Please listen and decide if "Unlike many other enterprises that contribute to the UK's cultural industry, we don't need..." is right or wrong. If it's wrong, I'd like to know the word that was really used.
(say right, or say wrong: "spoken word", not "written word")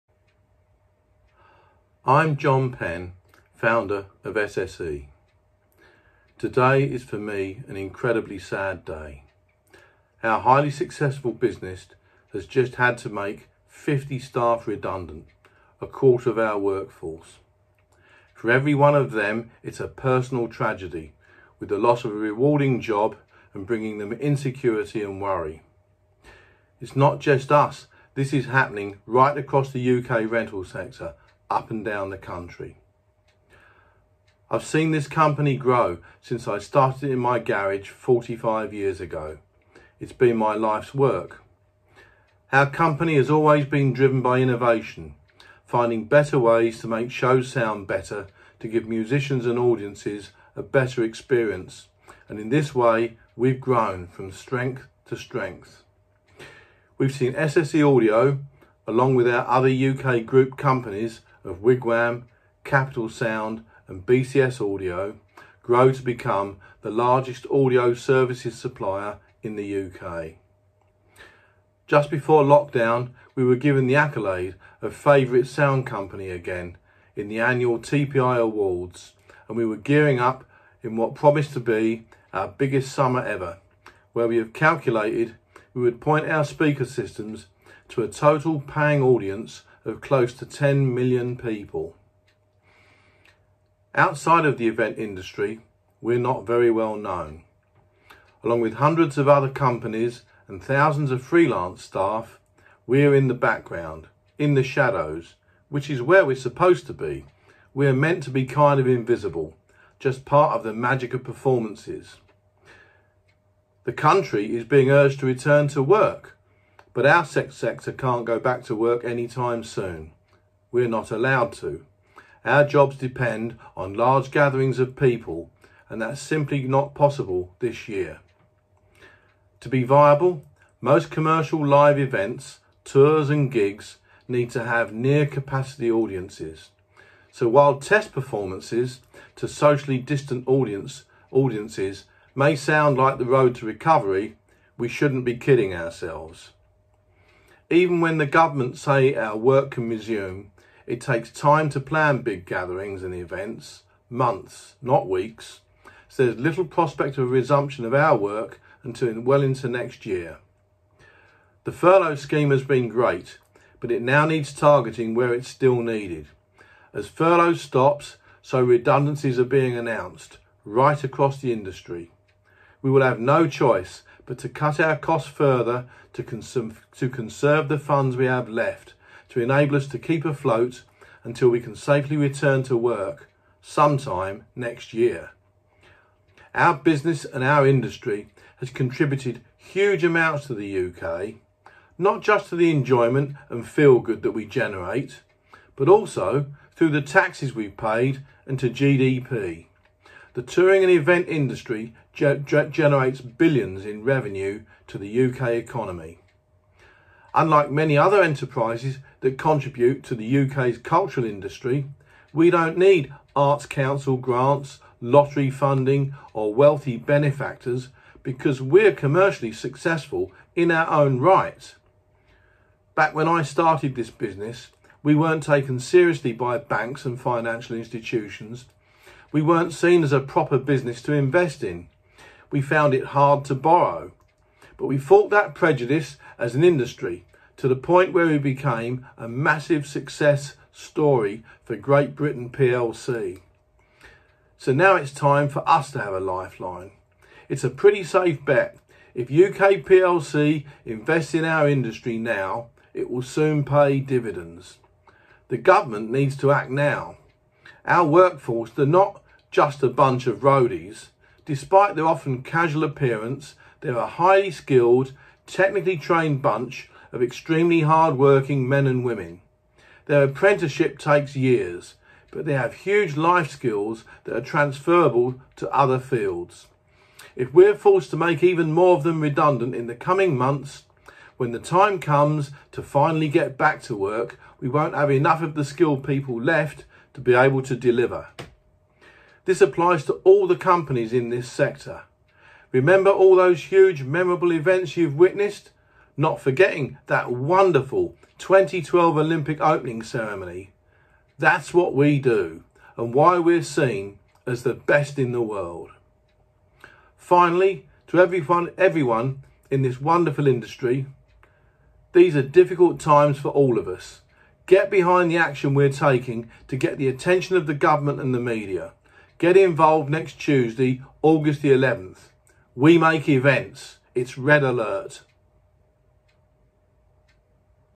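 right.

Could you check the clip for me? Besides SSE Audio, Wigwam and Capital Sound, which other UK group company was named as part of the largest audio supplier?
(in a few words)
BCS Audio.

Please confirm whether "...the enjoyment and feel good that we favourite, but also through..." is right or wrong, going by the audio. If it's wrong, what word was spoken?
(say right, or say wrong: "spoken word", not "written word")
wrong: "generate", not "favourite".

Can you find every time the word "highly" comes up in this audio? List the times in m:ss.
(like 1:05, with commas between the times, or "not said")
0:10, 4:24.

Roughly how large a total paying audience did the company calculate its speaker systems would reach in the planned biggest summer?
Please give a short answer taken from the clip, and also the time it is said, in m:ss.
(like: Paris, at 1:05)
close to 10 million, at 1:30.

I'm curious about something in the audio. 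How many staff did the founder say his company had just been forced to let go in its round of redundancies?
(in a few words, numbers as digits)
50.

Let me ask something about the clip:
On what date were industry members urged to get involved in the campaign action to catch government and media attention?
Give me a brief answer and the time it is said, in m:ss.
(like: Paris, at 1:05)
Tuesday, August 11th, at 5:20.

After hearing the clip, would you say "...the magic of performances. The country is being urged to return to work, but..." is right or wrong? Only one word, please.
right.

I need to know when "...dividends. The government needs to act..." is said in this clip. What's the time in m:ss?
4:13.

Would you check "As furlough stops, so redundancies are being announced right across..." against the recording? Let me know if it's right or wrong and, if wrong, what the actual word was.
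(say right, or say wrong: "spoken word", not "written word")
right.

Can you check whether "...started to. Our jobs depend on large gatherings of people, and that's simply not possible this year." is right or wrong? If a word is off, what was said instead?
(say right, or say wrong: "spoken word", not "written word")
wrong: "allowed", not "started".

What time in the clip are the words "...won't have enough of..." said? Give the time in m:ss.
4:44.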